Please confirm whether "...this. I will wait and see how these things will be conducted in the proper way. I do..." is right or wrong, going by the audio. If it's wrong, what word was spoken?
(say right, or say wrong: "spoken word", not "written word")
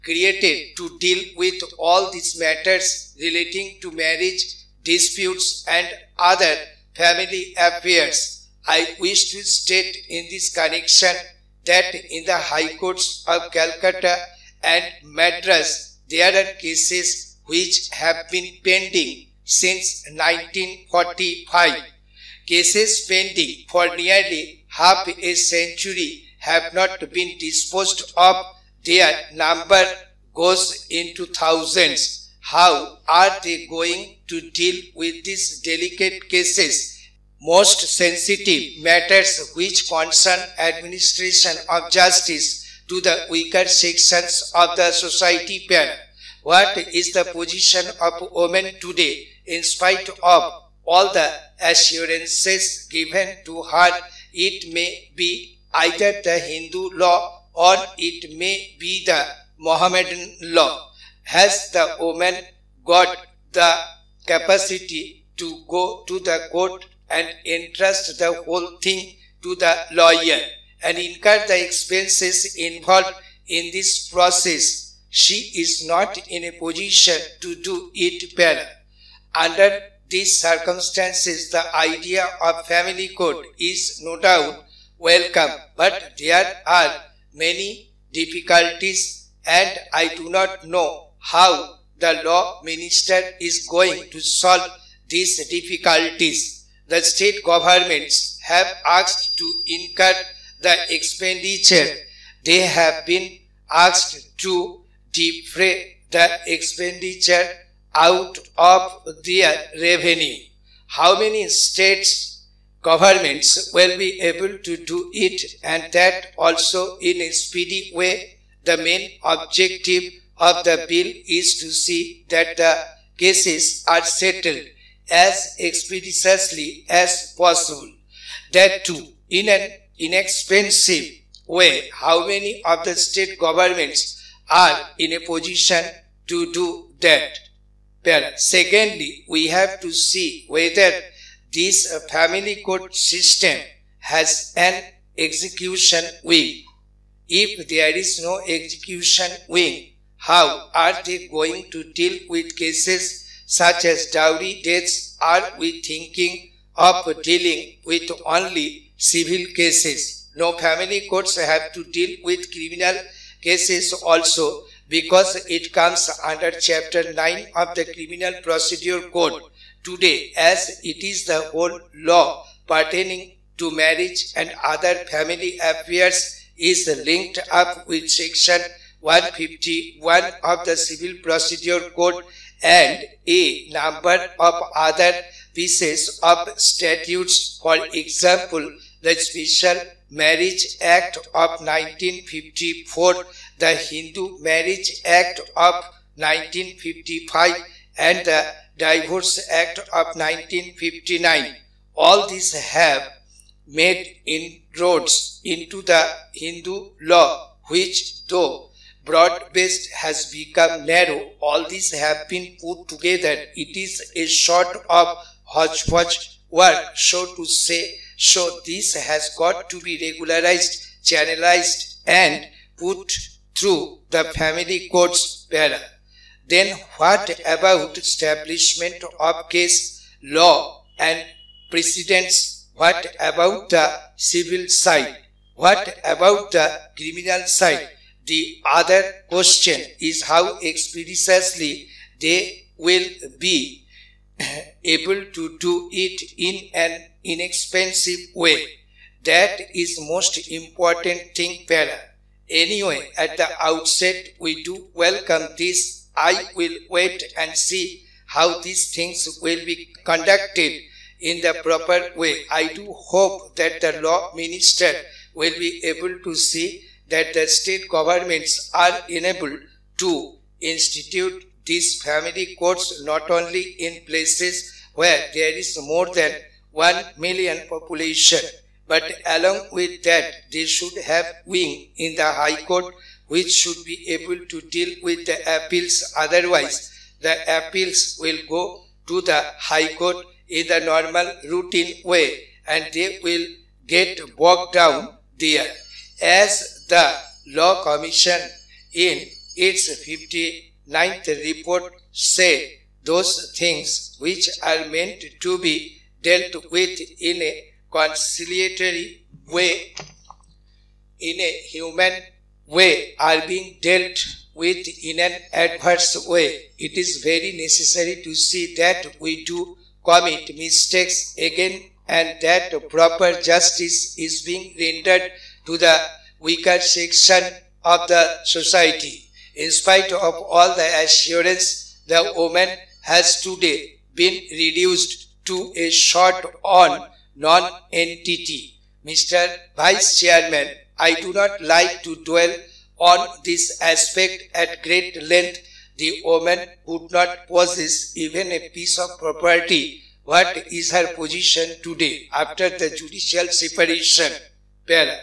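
right.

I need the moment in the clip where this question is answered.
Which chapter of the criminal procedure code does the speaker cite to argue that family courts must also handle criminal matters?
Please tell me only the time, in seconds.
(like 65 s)
166 s.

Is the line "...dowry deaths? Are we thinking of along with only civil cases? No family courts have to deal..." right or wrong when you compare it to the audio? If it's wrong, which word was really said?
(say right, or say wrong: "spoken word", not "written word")
wrong: "dealing", not "along".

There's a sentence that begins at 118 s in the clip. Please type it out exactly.
The main objective of the bill is to see that the cases are settled as expeditiously as possible.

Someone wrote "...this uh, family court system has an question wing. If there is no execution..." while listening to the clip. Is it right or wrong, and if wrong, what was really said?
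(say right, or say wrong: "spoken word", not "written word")
wrong: "execution", not "question".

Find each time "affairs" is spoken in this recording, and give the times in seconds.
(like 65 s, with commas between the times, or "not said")
7 s, 175 s.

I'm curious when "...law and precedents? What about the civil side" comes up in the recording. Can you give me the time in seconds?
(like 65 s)
230 s.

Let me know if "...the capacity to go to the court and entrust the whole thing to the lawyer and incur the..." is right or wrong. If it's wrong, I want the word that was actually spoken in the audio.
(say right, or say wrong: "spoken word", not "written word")
right.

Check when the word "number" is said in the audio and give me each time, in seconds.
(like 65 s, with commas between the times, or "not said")
29 s, 183 s.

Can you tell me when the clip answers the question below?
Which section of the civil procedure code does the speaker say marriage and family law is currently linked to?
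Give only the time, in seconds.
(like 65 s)
178 s.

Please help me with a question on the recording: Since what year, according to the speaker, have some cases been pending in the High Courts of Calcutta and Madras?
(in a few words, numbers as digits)
1945.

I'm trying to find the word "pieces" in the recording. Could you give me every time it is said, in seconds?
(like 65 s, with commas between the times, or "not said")
185 s, 348 s.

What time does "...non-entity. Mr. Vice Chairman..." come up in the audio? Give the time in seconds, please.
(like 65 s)
337 s.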